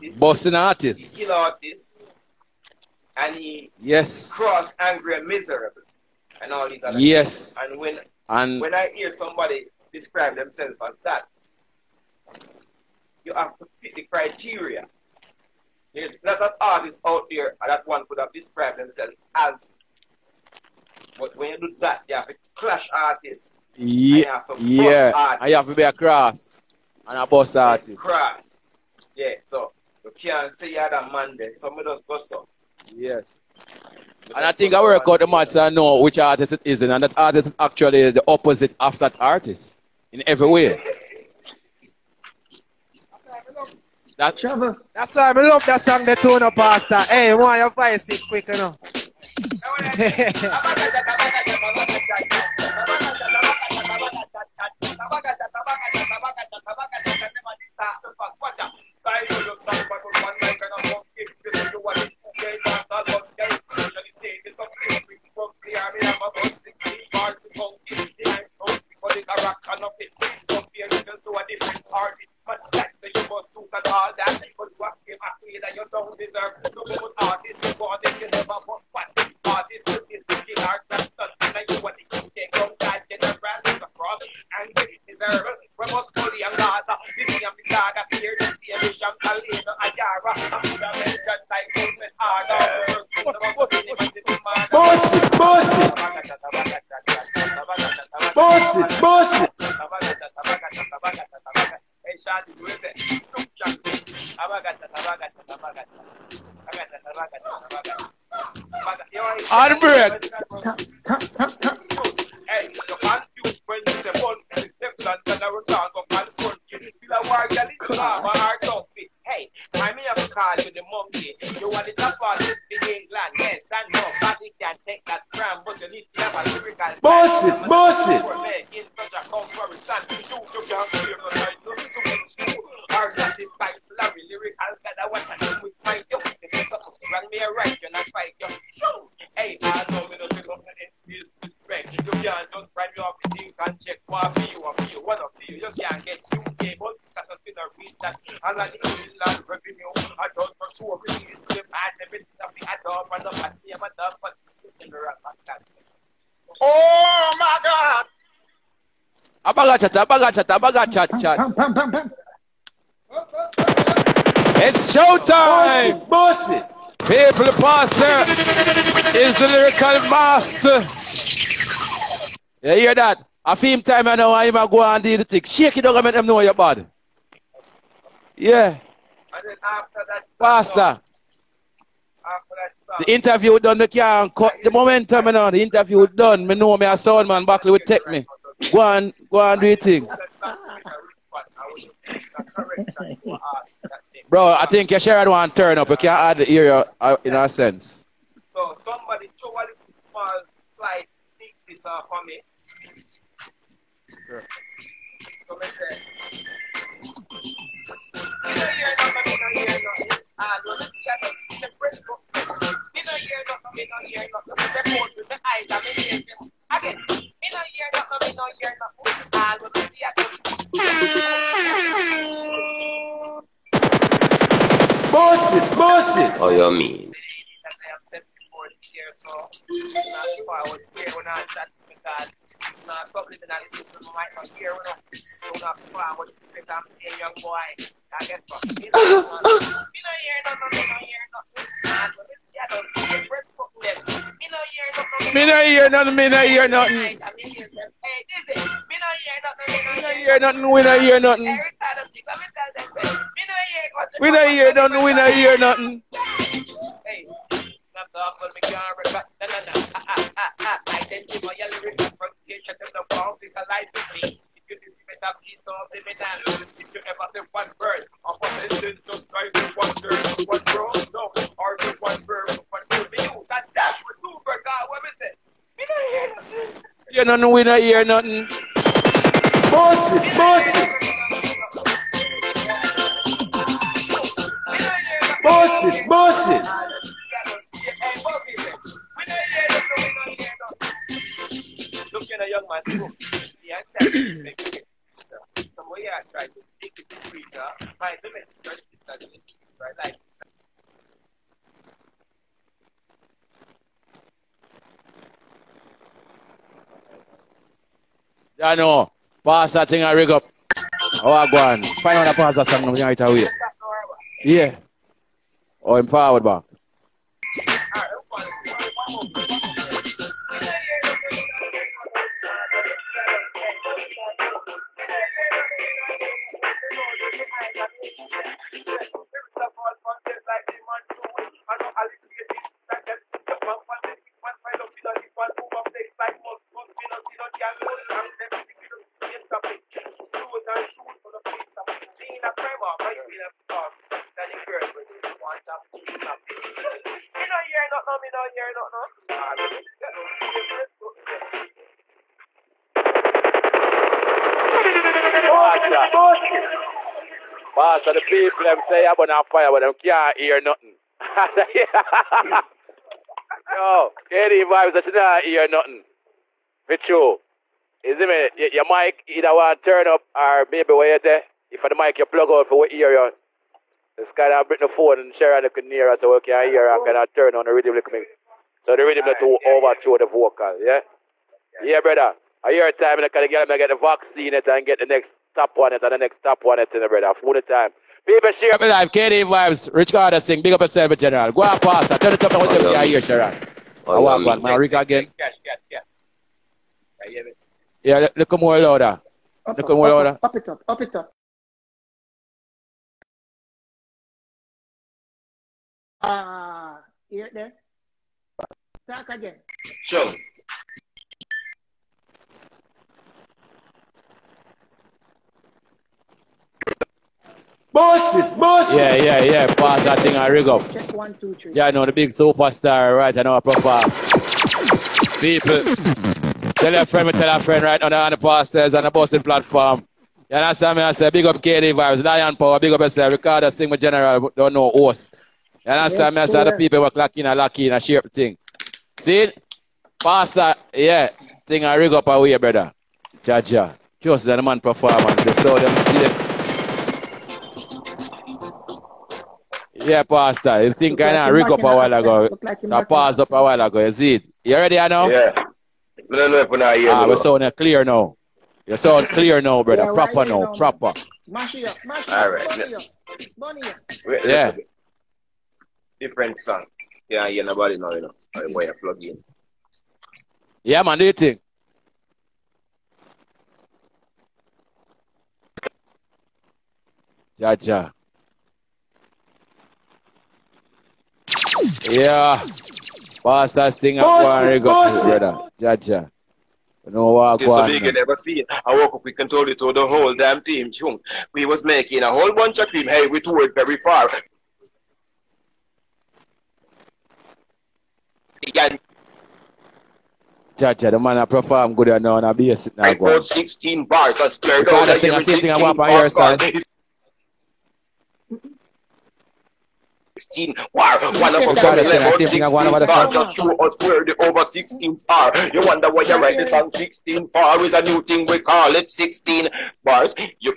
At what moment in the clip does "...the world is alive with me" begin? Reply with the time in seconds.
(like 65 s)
261 s.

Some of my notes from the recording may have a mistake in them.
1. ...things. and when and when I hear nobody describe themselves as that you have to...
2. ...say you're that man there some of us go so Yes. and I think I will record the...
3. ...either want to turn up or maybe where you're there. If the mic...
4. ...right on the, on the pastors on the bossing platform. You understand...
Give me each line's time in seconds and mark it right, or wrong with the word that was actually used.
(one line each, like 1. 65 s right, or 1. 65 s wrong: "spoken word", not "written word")
1. 7 s wrong: "somebody", not "nobody"
2. 30 s right
3. 369 s right
4. 427 s right.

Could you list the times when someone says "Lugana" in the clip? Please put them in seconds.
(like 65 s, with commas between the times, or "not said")
not said.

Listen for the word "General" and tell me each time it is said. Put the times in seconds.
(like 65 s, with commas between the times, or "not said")
391 s, 434 s.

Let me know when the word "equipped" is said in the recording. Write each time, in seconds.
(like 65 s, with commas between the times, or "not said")
not said.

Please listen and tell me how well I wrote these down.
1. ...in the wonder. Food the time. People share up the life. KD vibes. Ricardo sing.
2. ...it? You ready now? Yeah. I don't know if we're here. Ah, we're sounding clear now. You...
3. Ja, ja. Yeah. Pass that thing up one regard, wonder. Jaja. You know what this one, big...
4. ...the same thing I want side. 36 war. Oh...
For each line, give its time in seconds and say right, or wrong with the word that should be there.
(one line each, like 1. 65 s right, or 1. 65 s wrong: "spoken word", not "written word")
1. 386 s wrong: "brother", not "wonder"
2. 454 s right
3. 477 s wrong: "brother", not "wonder"
4. 505 s wrong: "16", not "36".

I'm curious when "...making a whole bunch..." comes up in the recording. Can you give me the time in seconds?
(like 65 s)
491 s.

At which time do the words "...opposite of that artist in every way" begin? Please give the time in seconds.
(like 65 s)
38 s.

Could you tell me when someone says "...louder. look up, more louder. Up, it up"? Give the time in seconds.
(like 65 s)
398 s.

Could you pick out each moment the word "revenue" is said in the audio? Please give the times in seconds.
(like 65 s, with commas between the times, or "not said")
149 s.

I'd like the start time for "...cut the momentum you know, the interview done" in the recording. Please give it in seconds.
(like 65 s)
184 s.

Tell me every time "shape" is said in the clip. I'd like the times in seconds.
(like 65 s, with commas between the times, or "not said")
438 s.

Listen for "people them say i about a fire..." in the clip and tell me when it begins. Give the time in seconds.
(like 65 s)
358 s.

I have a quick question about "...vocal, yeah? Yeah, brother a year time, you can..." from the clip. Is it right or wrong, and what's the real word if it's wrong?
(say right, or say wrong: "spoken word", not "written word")
right.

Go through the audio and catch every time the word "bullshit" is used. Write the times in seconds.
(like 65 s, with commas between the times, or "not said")
220 s, 225 s.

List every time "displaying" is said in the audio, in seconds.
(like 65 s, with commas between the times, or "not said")
not said.